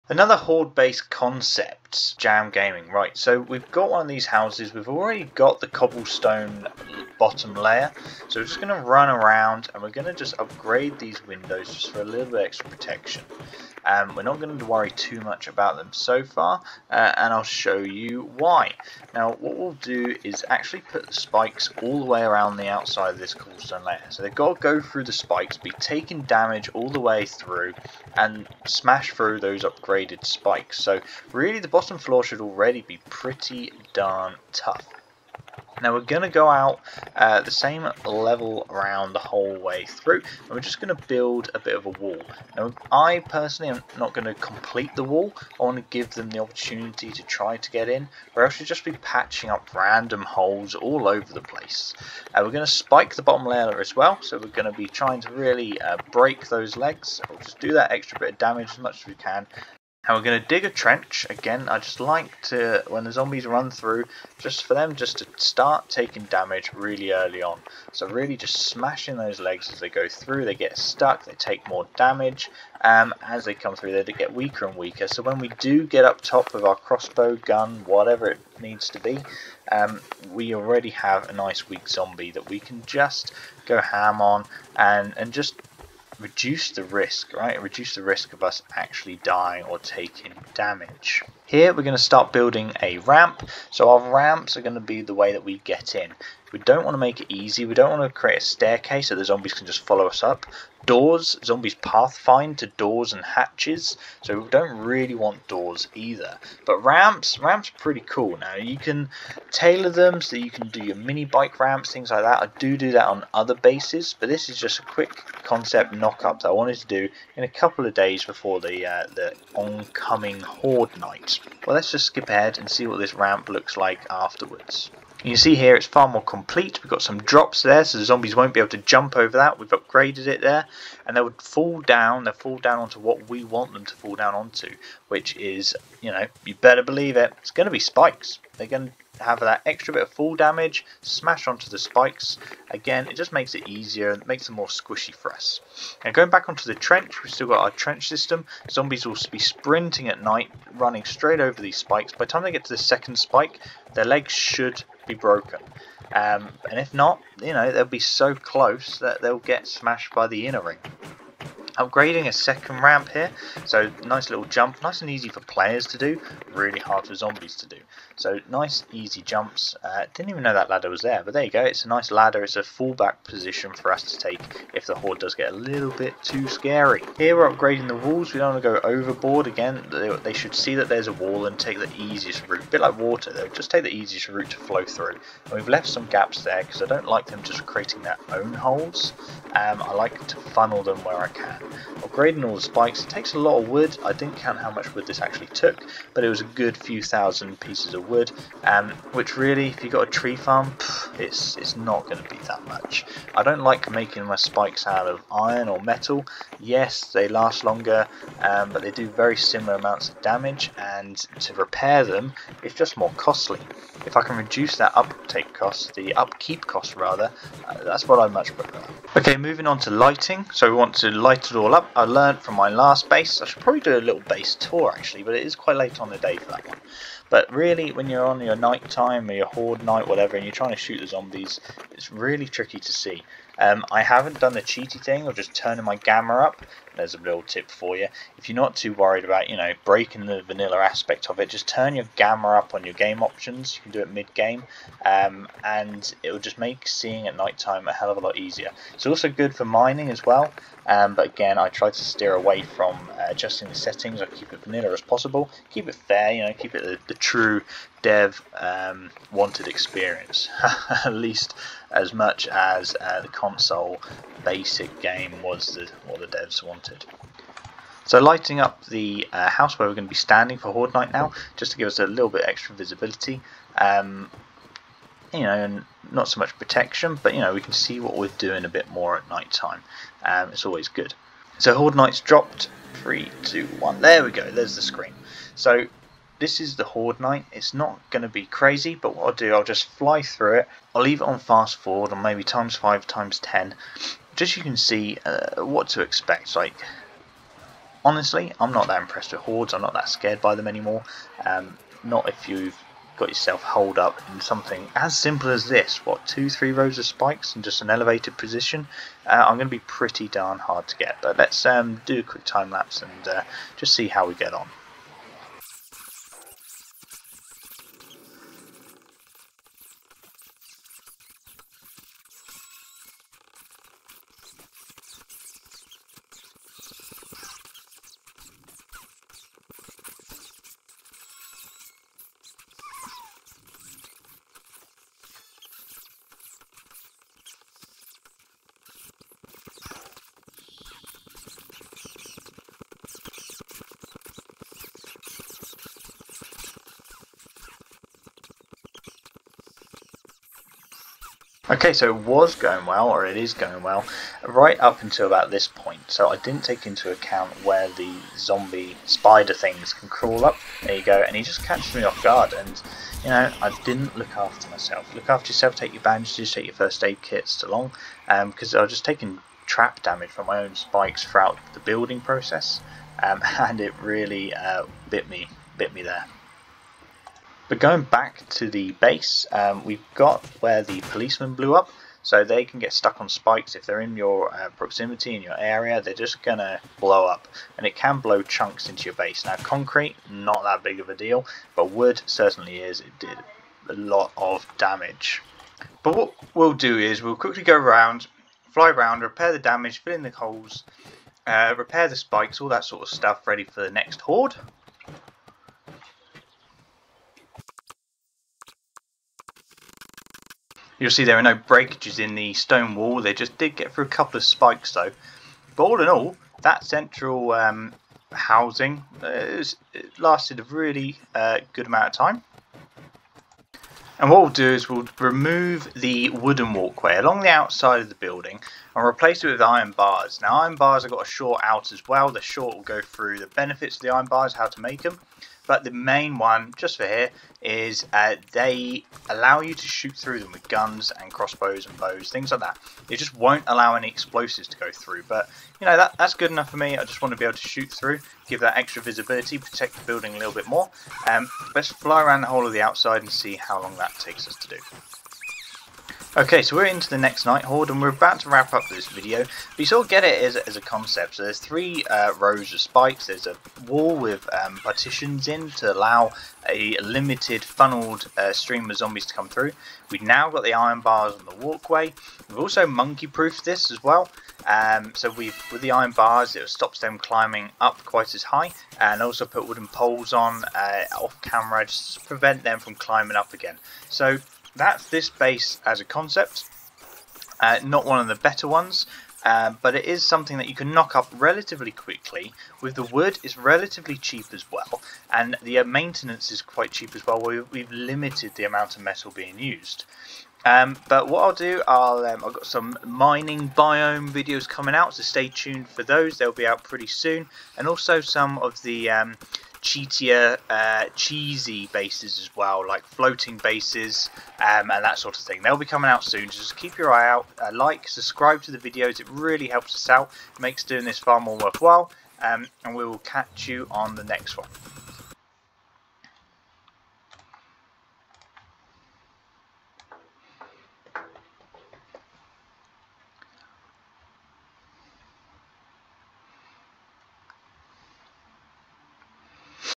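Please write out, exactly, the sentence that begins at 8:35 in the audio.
They'll be coming out soon, so just keep your eye out.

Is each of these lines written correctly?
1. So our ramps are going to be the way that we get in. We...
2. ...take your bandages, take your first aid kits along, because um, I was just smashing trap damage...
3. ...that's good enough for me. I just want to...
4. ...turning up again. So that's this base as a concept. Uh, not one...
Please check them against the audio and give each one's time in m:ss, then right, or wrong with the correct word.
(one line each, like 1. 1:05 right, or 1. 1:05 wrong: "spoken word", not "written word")
1. 1:33 right
2. 6:05 wrong: "taking", not "smashing"
3. 7:26 right
4. 8:02 wrong: "climbing", not "turning".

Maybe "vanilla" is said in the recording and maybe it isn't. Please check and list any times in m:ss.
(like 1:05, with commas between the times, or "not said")
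4:00, 4:14.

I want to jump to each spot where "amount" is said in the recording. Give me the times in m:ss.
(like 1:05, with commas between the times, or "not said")
3:29, 7:01, 8:18.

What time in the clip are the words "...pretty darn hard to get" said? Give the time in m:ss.
5:09.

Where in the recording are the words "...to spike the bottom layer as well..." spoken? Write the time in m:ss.
0:52.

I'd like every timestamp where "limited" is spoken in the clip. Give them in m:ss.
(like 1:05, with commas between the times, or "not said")
7:46, 8:17.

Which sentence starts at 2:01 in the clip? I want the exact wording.
Well, let's just skip ahead and see what this ramp looks like afterwards.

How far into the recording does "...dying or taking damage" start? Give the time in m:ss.
1:29.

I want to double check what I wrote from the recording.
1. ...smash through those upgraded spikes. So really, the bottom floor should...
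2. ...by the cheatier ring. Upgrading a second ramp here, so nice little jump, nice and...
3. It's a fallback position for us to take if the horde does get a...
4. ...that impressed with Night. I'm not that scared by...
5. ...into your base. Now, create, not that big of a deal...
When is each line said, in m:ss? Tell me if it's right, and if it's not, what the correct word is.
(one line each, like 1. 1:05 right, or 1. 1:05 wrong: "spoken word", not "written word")
1. 0:28 right
2. 2:40 wrong: "inner", not "cheatier"
3. 2:52 right
4. 4:58 wrong: "Hordes", not "Night"
5. 6:28 wrong: "concrete", not "create".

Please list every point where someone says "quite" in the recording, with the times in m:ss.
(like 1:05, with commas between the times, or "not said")
3:45, 7:58, 8:16.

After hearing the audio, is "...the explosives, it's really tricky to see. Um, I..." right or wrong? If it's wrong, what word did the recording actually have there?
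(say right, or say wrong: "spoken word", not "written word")
wrong: "zombies", not "explosives".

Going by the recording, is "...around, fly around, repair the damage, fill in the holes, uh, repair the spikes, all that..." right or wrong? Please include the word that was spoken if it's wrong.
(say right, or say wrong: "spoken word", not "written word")
right.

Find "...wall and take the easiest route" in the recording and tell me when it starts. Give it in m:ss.
3:01.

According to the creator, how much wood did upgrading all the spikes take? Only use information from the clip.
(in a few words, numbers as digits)
A good few thousand pieces.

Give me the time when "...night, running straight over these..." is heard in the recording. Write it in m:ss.
2:30.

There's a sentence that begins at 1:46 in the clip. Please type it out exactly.
But ramps, ramps are pretty cool now.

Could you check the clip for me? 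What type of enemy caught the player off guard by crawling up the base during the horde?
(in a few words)
Zombie spider.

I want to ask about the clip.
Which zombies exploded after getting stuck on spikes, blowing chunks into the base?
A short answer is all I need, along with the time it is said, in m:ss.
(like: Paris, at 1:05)
Policemen, at 6:20.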